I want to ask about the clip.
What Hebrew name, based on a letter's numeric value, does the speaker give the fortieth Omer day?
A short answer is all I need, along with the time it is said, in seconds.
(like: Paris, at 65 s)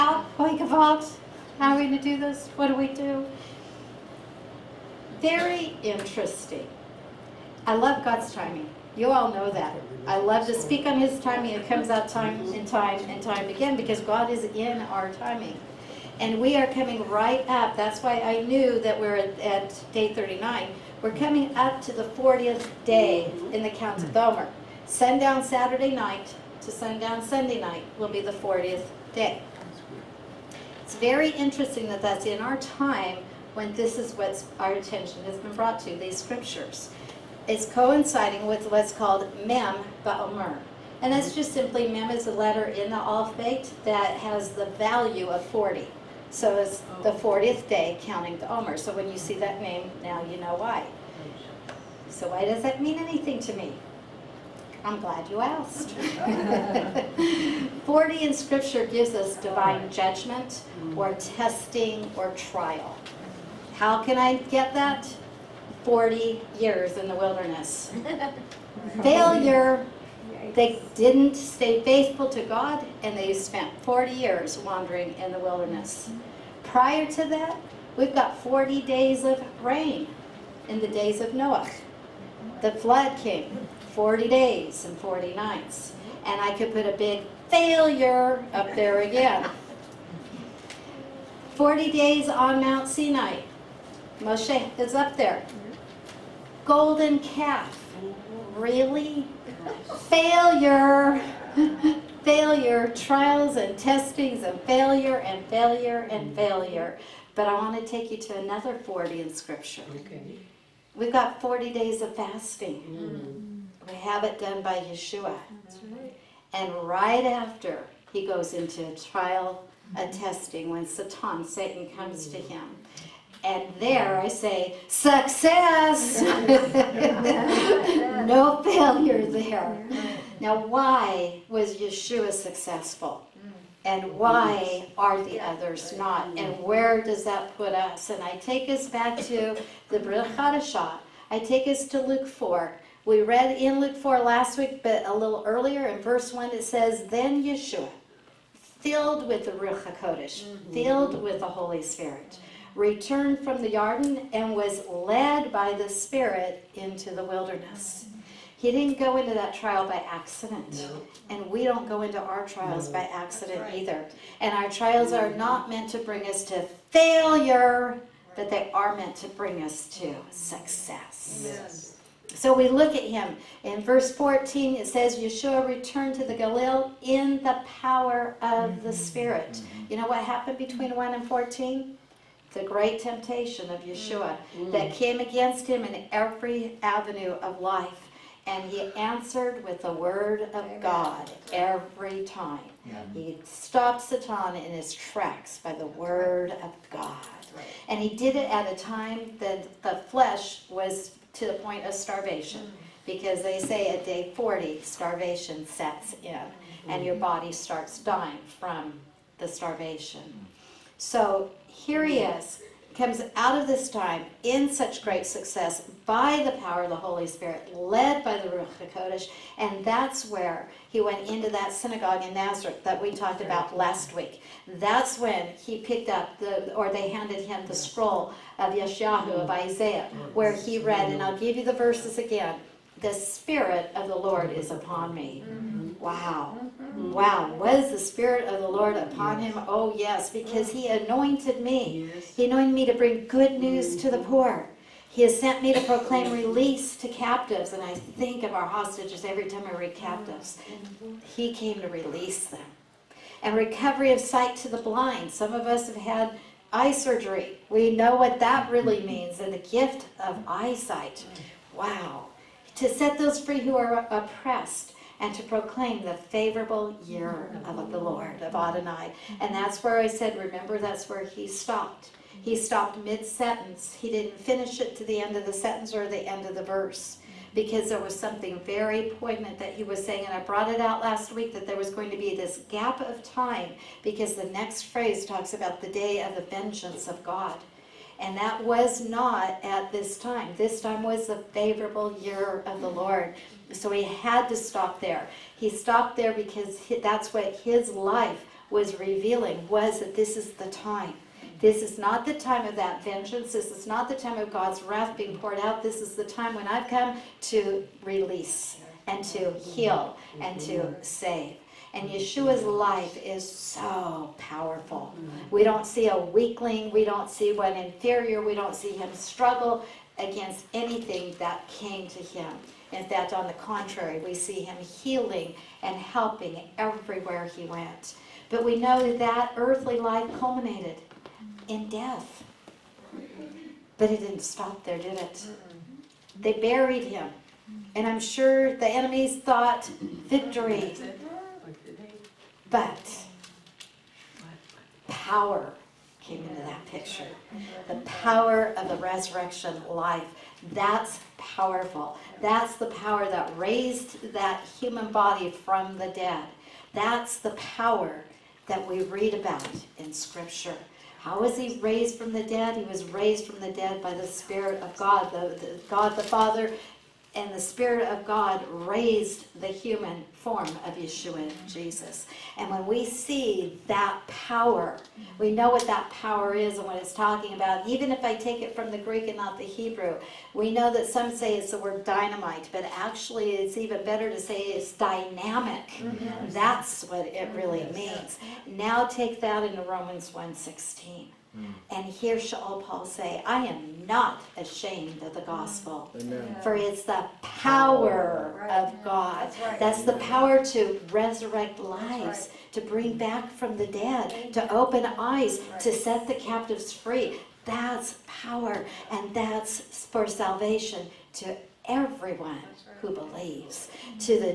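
Mem Ba'omer, at 39 s.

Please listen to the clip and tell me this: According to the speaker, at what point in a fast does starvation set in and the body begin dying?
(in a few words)
day 40.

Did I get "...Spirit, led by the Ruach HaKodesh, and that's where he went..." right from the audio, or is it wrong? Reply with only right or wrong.
right.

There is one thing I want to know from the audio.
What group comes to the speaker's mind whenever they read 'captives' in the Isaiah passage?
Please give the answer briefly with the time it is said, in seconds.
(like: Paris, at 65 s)
our hostages, at 248 s.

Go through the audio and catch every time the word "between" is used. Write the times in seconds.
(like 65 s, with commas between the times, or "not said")
180 s.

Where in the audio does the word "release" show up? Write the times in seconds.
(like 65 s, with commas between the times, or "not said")
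246 s, 252 s, 308 s.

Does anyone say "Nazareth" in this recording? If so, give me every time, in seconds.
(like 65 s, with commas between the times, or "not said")
222 s.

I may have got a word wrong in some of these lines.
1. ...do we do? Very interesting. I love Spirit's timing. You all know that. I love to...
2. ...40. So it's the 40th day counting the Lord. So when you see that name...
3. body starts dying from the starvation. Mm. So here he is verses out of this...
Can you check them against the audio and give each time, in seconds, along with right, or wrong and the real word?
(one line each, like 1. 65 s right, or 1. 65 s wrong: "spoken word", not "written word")
1. 2 s wrong: "God", not "Spirit"
2. 45 s wrong: "Omer", not "Lord"
3. 207 s wrong: "comes", not "verses".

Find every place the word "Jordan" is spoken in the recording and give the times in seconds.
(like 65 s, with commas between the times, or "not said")
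153 s.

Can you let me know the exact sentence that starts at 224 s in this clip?
That's when he picked up the, or they handed him the scroll of Yeshayahu, of mm.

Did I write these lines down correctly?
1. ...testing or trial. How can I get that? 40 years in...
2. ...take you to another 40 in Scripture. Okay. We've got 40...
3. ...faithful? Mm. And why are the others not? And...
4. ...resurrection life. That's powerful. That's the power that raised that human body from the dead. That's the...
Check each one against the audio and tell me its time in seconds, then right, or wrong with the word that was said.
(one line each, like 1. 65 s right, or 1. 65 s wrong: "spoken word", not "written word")
1. 61 s right
2. 107 s right
3. 132 s wrong: "successful", not "faithful"
4. 348 s right.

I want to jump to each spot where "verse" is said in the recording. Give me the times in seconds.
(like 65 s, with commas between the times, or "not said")
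146 s, 173 s, 231 s, 276 s.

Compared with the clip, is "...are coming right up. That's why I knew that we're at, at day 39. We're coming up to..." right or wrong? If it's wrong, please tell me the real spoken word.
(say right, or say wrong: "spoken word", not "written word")
right.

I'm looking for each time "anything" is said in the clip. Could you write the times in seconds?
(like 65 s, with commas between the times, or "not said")
52 s, 320 s.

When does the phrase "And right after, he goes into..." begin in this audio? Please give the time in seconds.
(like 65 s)
116 s.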